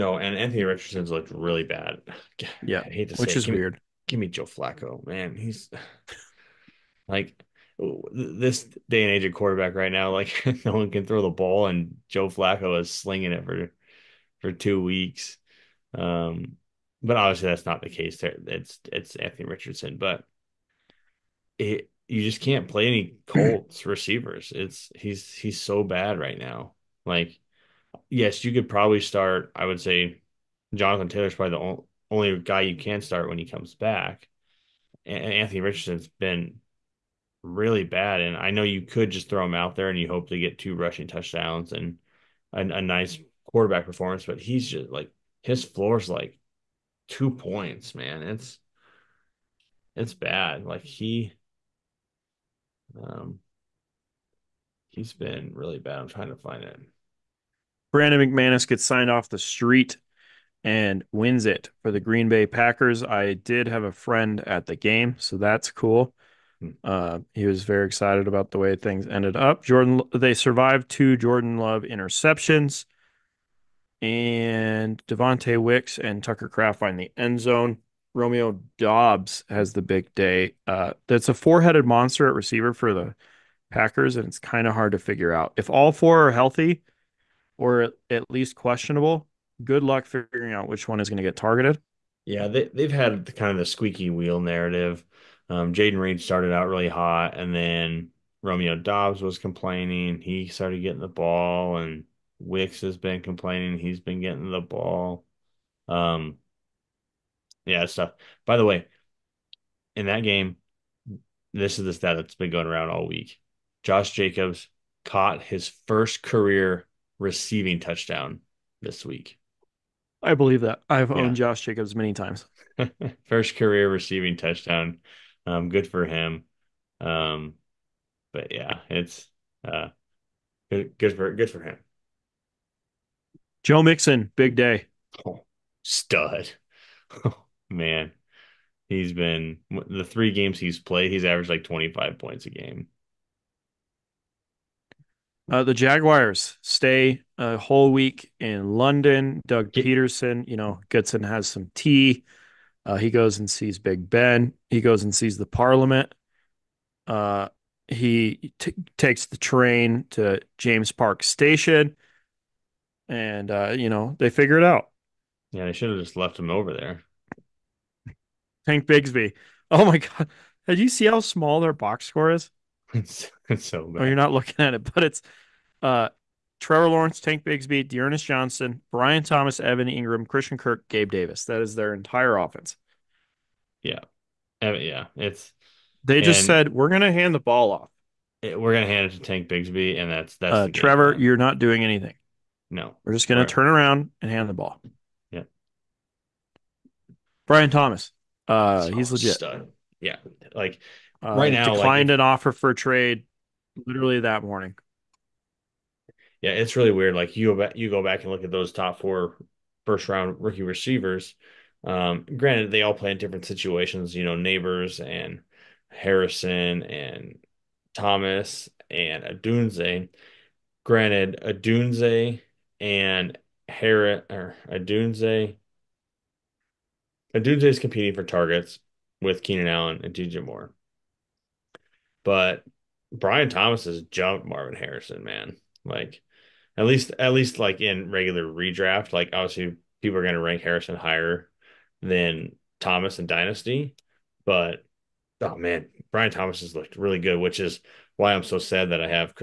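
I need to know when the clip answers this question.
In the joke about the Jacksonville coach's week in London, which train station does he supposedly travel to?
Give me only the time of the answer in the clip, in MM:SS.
02:40.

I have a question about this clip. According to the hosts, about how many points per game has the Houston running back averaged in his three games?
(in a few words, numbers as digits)
25.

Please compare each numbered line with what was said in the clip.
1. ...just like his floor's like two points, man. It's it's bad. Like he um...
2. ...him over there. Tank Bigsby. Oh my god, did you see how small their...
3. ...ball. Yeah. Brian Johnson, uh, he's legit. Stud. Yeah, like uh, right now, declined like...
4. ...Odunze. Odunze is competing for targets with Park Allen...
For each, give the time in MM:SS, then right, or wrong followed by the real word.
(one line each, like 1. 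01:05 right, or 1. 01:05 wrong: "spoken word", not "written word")
1. 00:44 right
2. 02:46 right
3. 03:14 wrong: "Thomas", not "Johnson"
4. 03:44 wrong: "Keenan", not "Park".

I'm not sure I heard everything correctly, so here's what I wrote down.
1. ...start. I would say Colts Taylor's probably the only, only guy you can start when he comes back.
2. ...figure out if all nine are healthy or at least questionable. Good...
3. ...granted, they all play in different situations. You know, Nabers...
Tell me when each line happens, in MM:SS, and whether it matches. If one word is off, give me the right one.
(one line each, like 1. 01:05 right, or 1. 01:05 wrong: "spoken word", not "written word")
1. 00:29 wrong: "Jonathan", not "Colts"
2. 01:24 wrong: "four", not "nine"
3. 03:32 right.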